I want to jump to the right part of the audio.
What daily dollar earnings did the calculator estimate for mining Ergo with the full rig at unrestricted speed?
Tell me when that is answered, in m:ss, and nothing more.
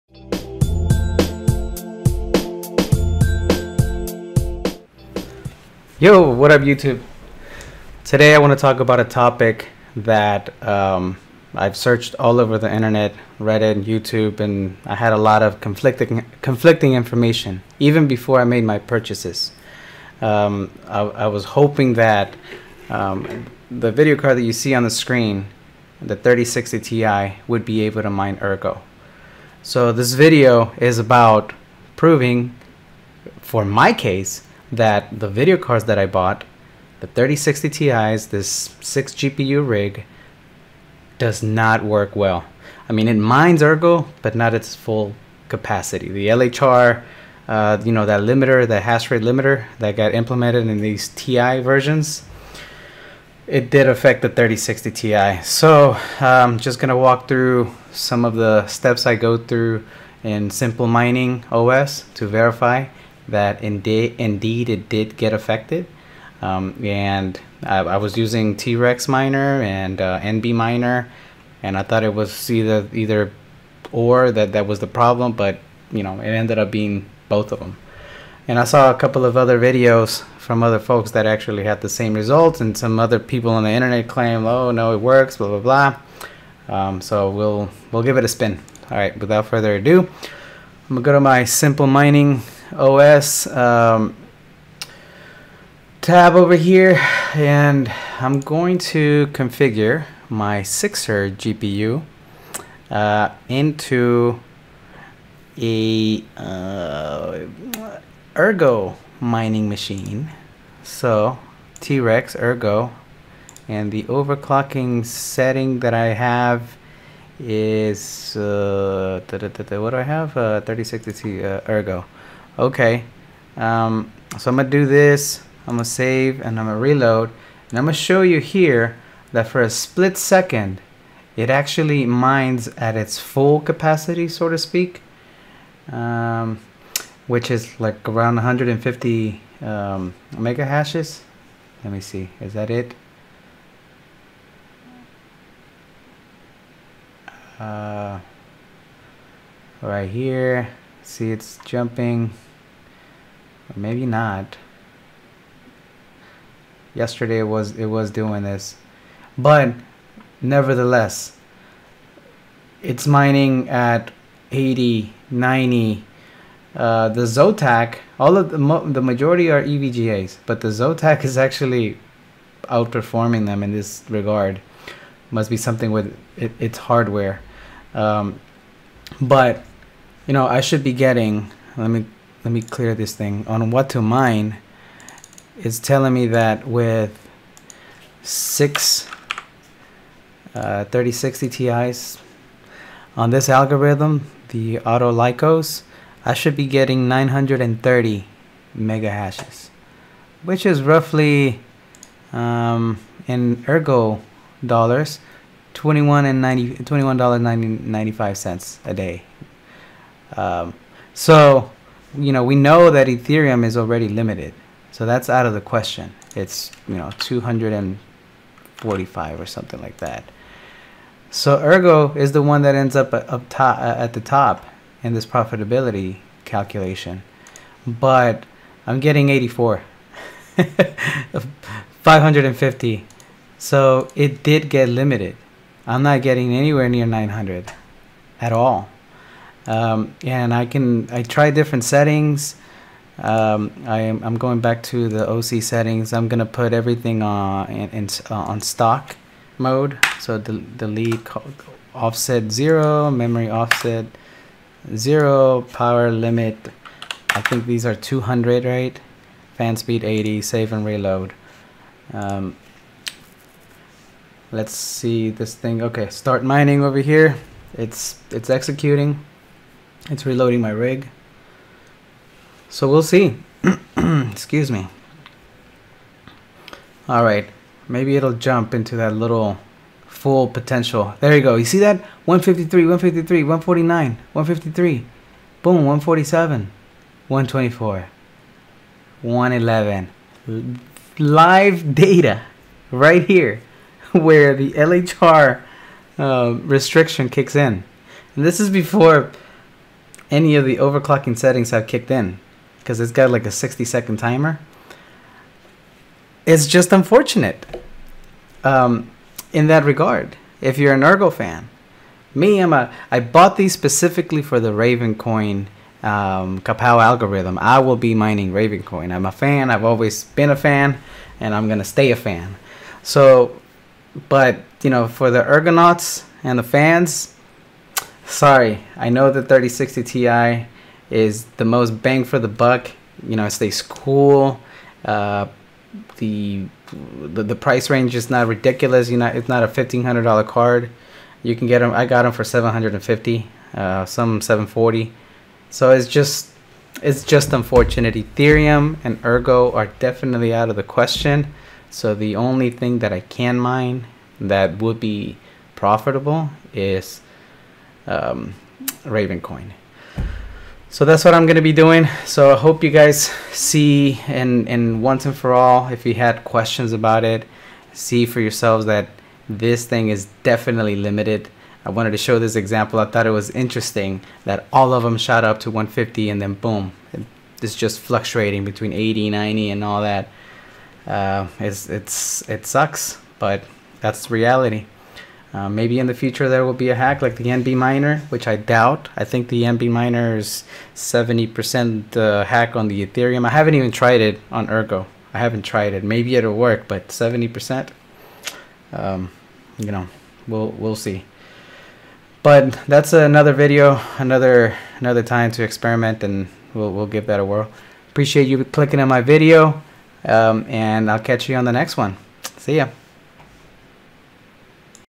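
3:25.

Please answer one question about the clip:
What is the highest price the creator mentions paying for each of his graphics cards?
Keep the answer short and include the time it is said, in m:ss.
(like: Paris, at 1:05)
$750, at 5:42.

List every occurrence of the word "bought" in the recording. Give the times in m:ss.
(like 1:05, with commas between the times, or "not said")
0:36, 5:13.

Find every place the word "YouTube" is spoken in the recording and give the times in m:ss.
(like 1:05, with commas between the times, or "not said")
0:06, 0:13.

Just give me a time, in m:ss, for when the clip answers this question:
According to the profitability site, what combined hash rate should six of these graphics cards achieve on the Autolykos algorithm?
3:17.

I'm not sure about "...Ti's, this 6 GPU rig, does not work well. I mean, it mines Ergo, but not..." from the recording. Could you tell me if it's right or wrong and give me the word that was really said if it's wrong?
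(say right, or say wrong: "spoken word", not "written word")
right.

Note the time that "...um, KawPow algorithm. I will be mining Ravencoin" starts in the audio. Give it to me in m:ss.
5:16.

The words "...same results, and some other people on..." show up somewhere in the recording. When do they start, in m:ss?
1:21.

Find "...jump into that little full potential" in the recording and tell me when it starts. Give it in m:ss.
4:38.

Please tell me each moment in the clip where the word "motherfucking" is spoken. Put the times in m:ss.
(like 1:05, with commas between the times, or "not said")
not said.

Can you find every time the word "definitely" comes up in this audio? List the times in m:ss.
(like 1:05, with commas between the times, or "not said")
5:49, 6:10.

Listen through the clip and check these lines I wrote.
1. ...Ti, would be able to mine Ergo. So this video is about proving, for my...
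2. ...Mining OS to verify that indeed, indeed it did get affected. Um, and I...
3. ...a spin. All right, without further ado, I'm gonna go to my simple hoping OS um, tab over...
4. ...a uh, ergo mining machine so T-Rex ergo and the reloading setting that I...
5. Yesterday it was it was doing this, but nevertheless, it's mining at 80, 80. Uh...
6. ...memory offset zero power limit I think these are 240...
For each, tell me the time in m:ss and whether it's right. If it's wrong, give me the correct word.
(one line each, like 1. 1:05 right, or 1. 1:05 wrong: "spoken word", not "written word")
1. 0:26 right
2. 1:00 right
3. 1:28 wrong: "mining", not "hoping"
4. 1:45 wrong: "overclocking", not "reloading"
5. 2:36 wrong: "90", not "80"
6. 4:13 wrong: "200", not "240".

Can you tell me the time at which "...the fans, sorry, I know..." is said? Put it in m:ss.
5:26.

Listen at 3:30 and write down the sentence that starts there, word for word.
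Um, so, you know, we know that Ethereum is already limited.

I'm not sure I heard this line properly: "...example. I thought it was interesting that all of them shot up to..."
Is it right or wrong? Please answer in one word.
right.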